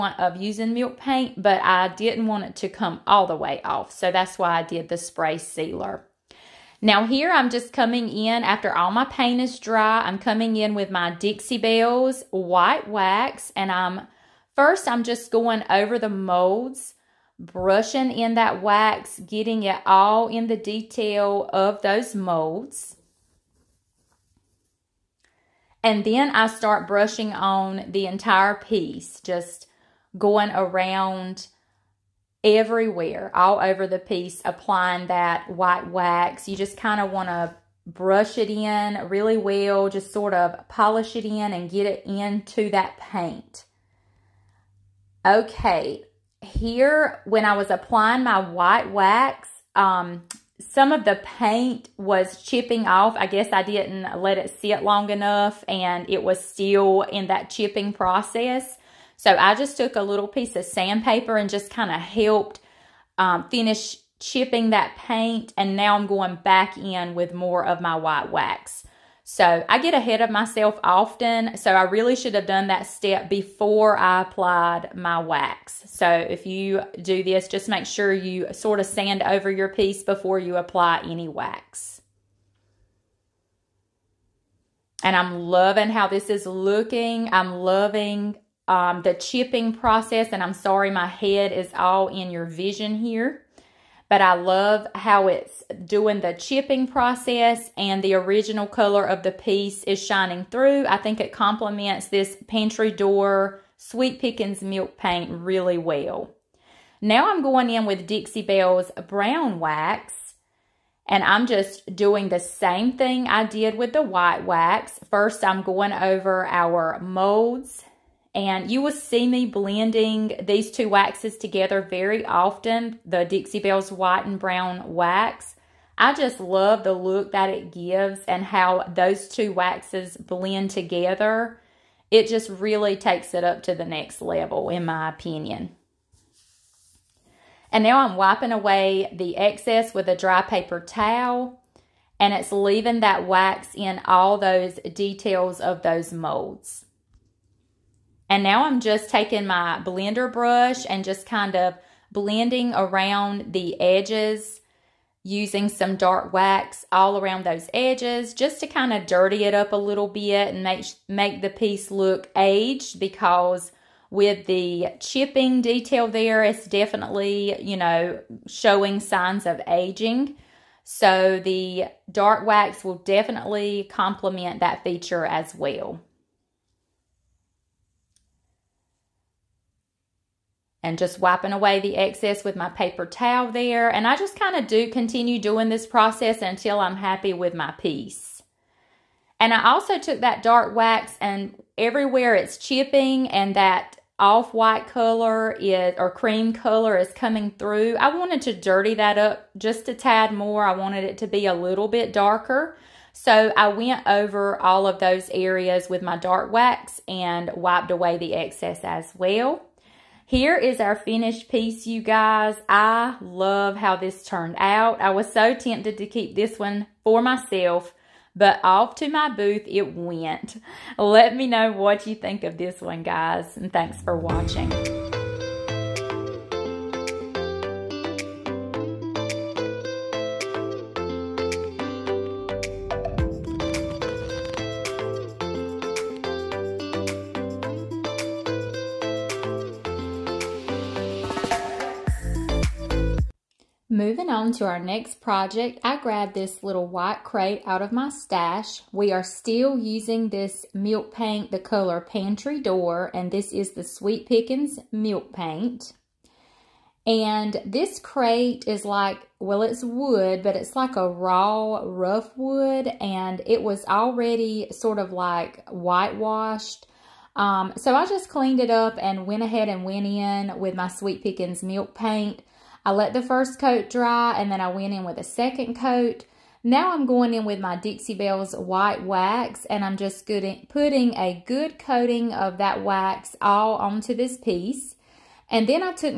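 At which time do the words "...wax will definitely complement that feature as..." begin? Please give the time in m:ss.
2:52.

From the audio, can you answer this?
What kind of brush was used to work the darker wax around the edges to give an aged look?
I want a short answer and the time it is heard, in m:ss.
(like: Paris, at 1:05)
blender brush, at 2:29.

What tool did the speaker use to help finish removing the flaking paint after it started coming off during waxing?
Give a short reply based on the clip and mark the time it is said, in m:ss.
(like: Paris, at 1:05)
sandpaper, at 1:00.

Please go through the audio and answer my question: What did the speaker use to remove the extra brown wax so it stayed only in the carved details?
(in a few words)
dry paper towel.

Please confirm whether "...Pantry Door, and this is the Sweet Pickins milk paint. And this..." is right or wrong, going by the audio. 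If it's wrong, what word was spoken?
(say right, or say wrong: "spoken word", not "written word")
right.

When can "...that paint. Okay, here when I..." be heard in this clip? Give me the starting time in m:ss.
0:42.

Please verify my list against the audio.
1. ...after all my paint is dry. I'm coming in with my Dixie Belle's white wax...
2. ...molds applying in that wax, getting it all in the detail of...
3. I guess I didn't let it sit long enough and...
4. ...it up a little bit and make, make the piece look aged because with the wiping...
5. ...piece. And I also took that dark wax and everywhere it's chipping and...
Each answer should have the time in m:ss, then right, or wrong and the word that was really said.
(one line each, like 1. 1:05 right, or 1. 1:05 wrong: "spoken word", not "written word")
1. 0:08 right
2. 0:16 wrong: "brushing", not "applying"
3. 0:53 right
4. 2:39 wrong: "chipping", not "wiping"
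5. 3:07 right.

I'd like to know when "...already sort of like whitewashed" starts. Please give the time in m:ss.
4:23.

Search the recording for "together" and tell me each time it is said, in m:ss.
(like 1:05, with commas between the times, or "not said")
2:01, 2:10.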